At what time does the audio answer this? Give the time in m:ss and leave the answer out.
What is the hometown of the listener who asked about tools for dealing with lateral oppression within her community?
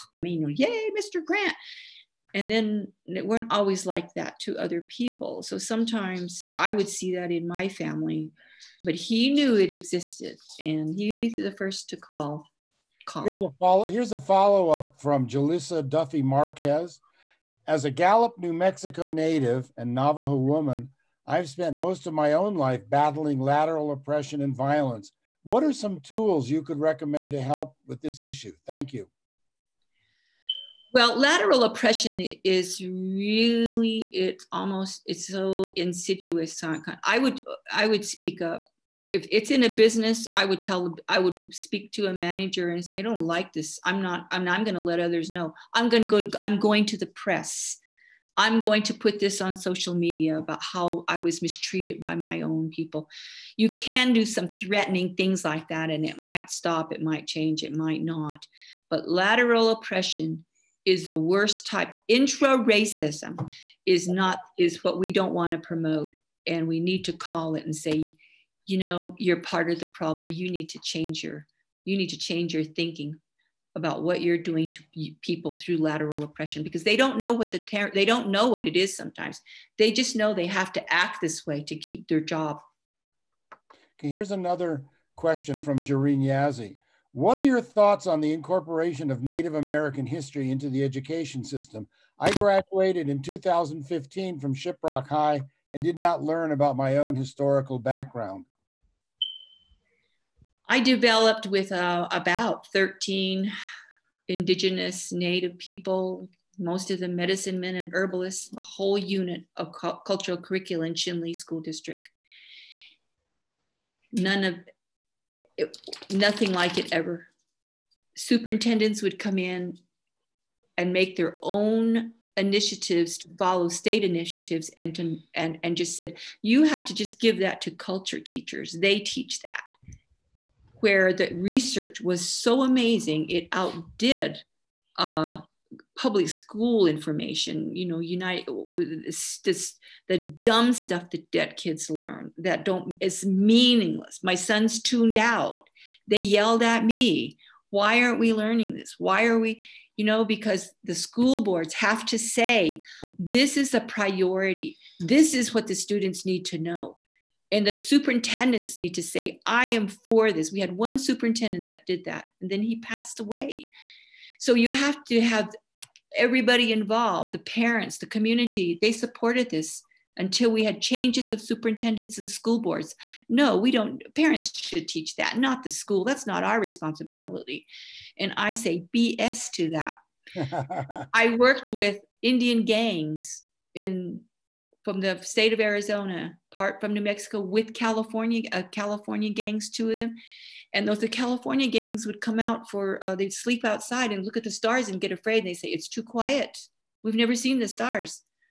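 0:17.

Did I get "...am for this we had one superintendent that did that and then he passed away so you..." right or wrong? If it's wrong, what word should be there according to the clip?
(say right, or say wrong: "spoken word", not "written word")
right.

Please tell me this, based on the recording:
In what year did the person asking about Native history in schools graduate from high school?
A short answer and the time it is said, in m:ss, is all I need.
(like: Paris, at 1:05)
2015, at 1:33.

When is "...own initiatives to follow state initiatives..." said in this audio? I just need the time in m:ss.
2:01.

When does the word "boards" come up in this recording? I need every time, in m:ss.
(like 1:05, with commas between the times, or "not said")
2:31, 2:52.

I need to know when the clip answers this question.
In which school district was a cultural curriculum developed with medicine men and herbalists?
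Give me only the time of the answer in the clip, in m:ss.
1:50.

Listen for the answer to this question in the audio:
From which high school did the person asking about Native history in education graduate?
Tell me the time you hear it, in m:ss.
1:34.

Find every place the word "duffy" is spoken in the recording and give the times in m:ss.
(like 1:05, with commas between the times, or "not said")
0:15.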